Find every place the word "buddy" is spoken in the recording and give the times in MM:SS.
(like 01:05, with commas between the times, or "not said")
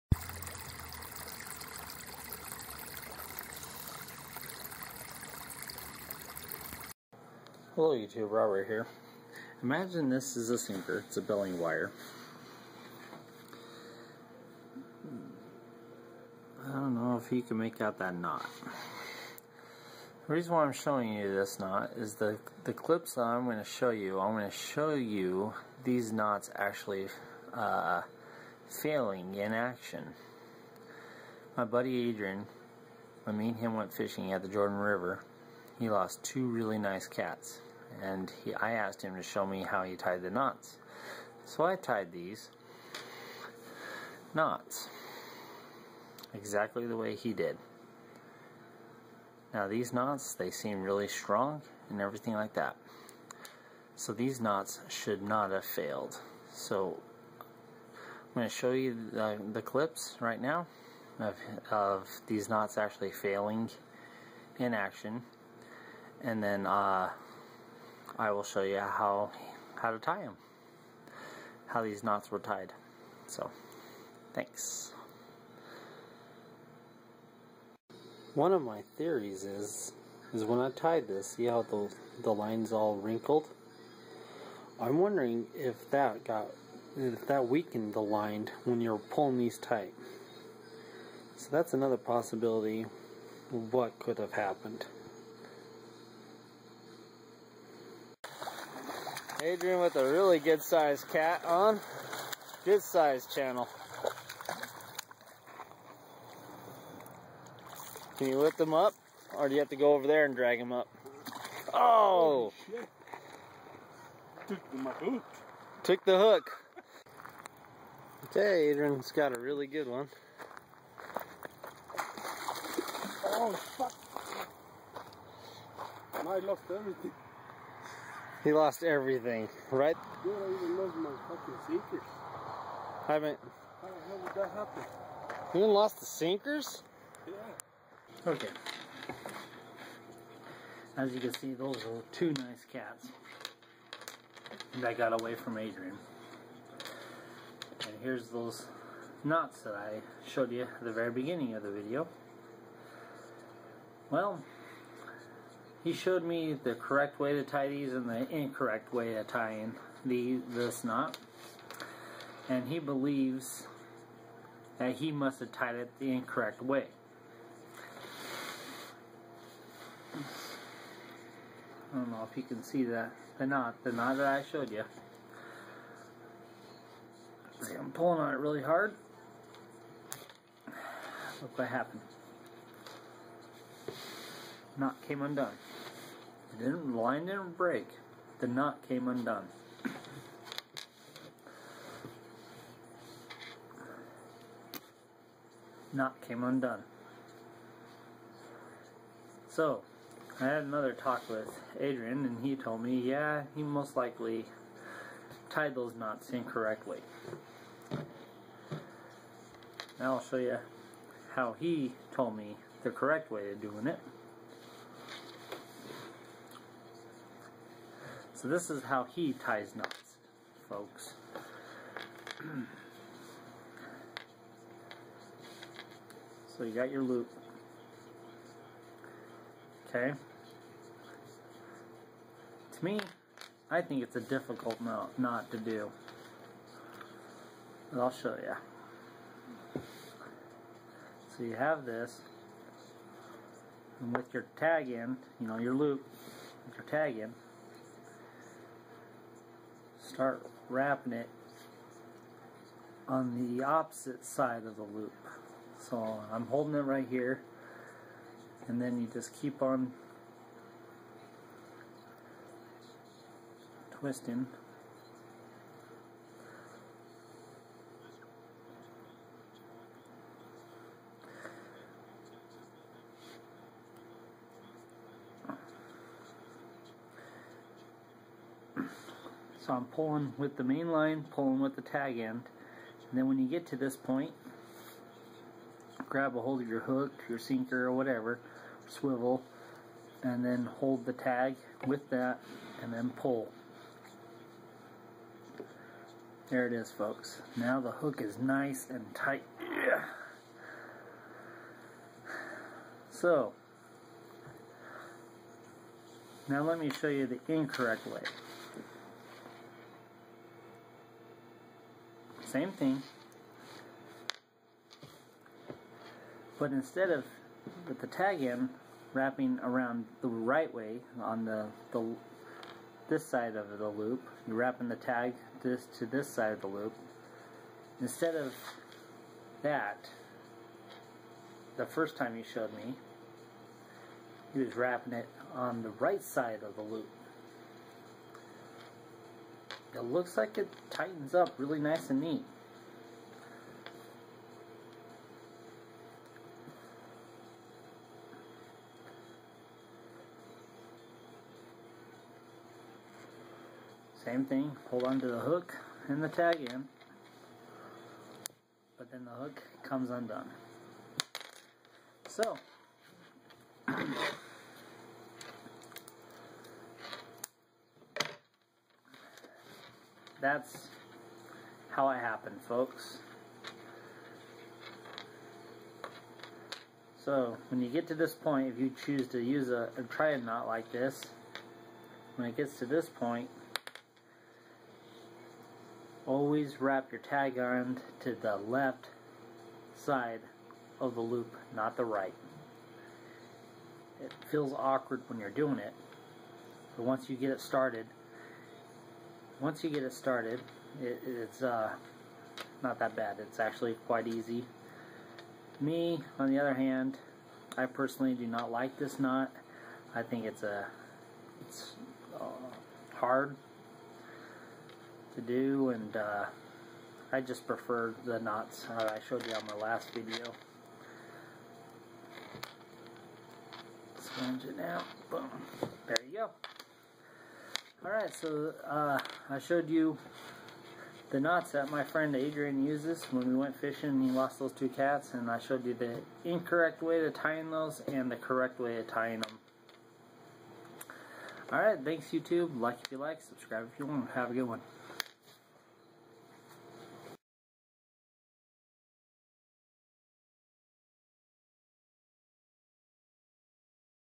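00:31.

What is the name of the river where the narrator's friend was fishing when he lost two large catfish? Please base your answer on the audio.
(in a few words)
Jordan River.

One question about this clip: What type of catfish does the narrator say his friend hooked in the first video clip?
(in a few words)
Channel.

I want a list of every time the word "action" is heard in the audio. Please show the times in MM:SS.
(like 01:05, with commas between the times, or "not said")
00:29, 01:04.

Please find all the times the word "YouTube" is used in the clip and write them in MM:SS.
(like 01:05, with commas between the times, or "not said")
00:07, 07:22.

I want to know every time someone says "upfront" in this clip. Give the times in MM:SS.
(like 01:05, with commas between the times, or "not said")
not said.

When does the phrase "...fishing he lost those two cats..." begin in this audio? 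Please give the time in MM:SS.
07:13.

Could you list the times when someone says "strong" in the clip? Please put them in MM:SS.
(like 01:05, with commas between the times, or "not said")
00:51.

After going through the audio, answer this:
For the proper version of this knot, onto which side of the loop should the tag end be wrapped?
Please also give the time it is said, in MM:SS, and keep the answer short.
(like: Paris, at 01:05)
Left, at 06:28.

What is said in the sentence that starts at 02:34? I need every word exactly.
Well, he showed me the correct way to tie these and the incorrect way to tie in the, this knot.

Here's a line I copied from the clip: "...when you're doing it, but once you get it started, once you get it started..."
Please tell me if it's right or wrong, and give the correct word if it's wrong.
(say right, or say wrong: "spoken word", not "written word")
right.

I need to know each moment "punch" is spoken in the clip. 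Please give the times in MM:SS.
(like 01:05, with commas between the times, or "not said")
not said.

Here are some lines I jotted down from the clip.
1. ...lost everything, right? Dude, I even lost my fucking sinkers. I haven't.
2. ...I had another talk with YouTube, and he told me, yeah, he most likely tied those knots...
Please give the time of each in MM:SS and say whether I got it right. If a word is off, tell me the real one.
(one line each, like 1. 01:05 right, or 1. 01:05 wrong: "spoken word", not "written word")
1. 02:08 right
2. 03:20 wrong: "Adrian", not "YouTube".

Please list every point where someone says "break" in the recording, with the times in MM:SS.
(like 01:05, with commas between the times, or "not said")
03:07.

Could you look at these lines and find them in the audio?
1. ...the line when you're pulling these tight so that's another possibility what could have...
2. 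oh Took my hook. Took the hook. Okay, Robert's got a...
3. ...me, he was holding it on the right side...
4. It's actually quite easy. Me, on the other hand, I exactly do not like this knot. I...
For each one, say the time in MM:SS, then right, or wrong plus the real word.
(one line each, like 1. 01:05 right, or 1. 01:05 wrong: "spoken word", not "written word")
1. 01:27 right
2. 01:52 wrong: "Adrian", not "Robert"
3. 05:32 wrong: "wrapping", not "holding"
4. 06:43 wrong: "personally", not "exactly".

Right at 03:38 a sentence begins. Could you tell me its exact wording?
So this is how he ties knots, folks.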